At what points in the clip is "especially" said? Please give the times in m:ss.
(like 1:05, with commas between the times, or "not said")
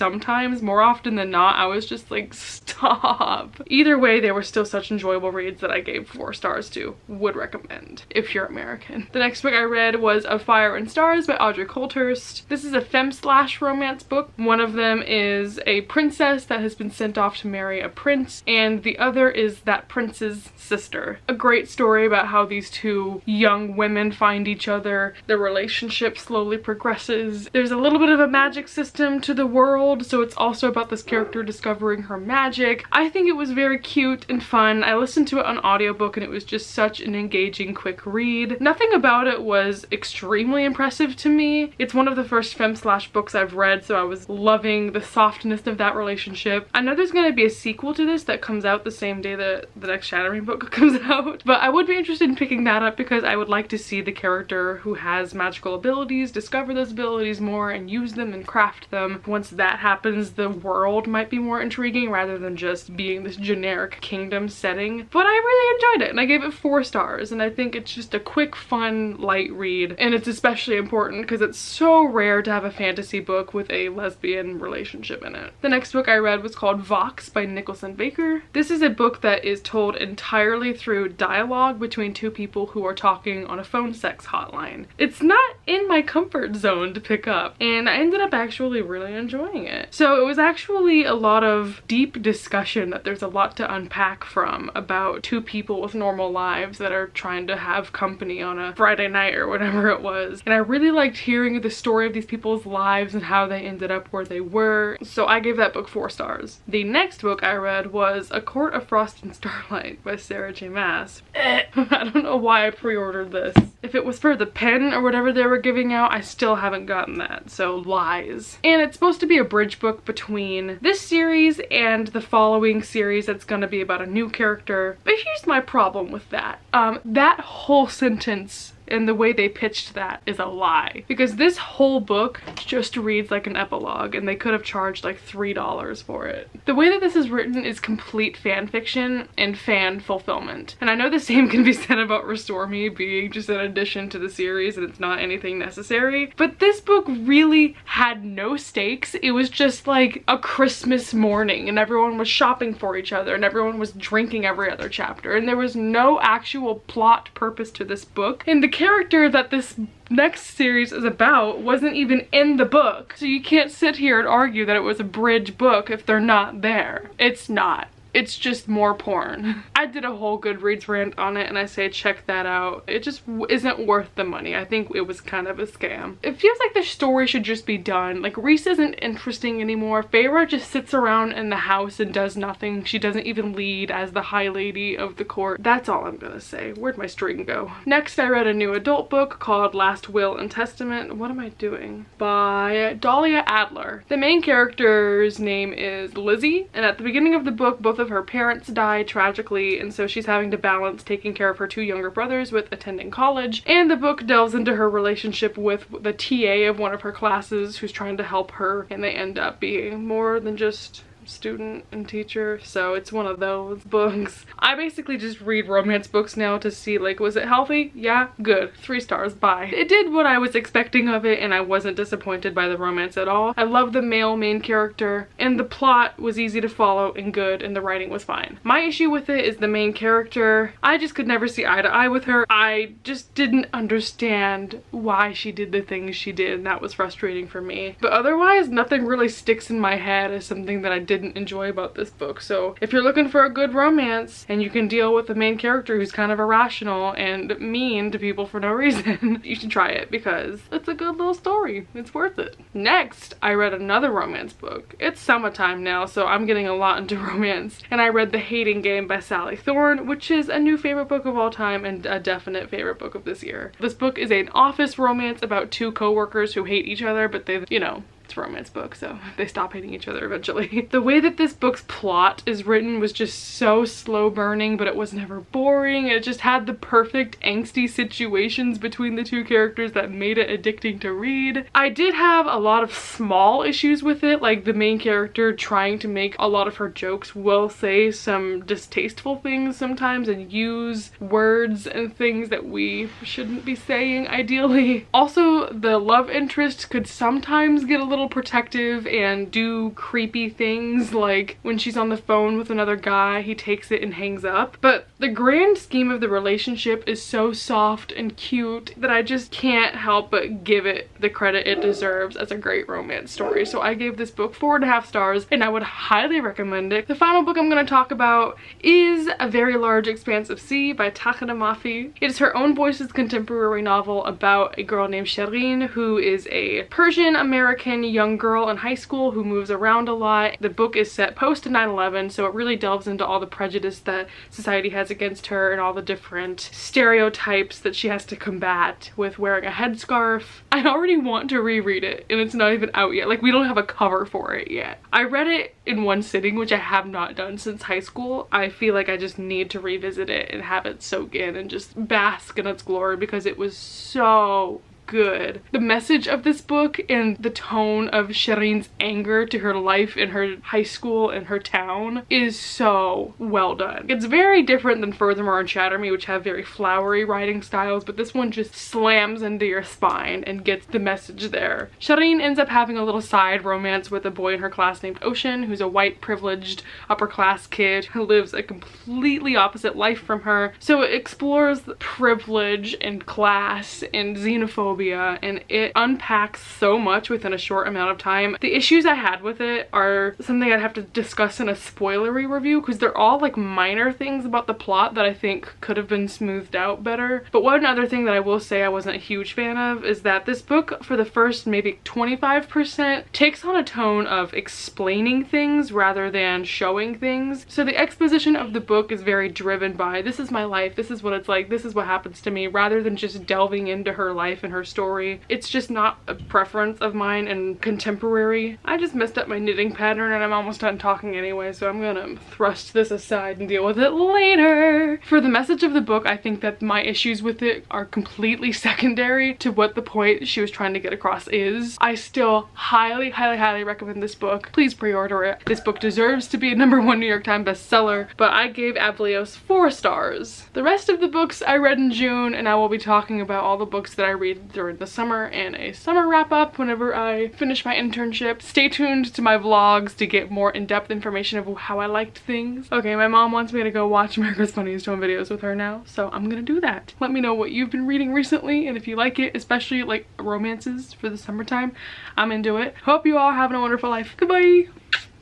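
1:10, 7:39.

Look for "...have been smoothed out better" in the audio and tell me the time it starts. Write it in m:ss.
6:35.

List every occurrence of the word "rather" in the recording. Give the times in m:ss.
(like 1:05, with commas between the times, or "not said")
1:02, 6:45, 6:52.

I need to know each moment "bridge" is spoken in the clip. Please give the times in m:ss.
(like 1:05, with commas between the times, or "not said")
1:59, 2:45.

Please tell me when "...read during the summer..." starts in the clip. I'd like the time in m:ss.
7:24.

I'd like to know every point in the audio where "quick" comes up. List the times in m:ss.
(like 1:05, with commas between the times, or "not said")
0:37, 1:08.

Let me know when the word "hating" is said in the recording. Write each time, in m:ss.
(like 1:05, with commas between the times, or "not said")
4:18, 4:29.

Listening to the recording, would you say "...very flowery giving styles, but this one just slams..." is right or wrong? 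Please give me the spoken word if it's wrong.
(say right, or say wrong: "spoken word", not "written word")
wrong: "writing", not "giving".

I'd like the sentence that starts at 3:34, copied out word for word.
I basically just read romance books now to see like, was it healthy?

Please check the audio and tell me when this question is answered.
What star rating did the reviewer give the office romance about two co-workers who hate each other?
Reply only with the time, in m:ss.
5:14.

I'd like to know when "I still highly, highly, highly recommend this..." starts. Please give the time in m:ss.
7:11.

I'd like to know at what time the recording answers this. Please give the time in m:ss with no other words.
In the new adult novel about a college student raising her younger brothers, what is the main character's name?
3:16.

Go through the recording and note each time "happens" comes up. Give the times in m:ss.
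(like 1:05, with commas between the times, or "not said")
0:59, 6:52.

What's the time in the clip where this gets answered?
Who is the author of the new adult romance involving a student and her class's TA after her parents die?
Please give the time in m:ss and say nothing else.
3:12.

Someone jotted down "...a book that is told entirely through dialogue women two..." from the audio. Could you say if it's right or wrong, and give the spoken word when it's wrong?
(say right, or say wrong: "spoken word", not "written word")
wrong: "between", not "women".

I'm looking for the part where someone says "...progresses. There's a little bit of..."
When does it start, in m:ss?
0:26.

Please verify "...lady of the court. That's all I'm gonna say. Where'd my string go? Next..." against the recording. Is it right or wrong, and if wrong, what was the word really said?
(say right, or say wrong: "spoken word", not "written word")
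right.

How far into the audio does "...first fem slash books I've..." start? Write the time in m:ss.
0:42.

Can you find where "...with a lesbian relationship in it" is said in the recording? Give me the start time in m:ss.
1:13.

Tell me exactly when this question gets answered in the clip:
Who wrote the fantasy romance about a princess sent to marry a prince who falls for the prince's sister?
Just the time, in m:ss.
0:11.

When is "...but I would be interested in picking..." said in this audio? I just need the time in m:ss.
0:51.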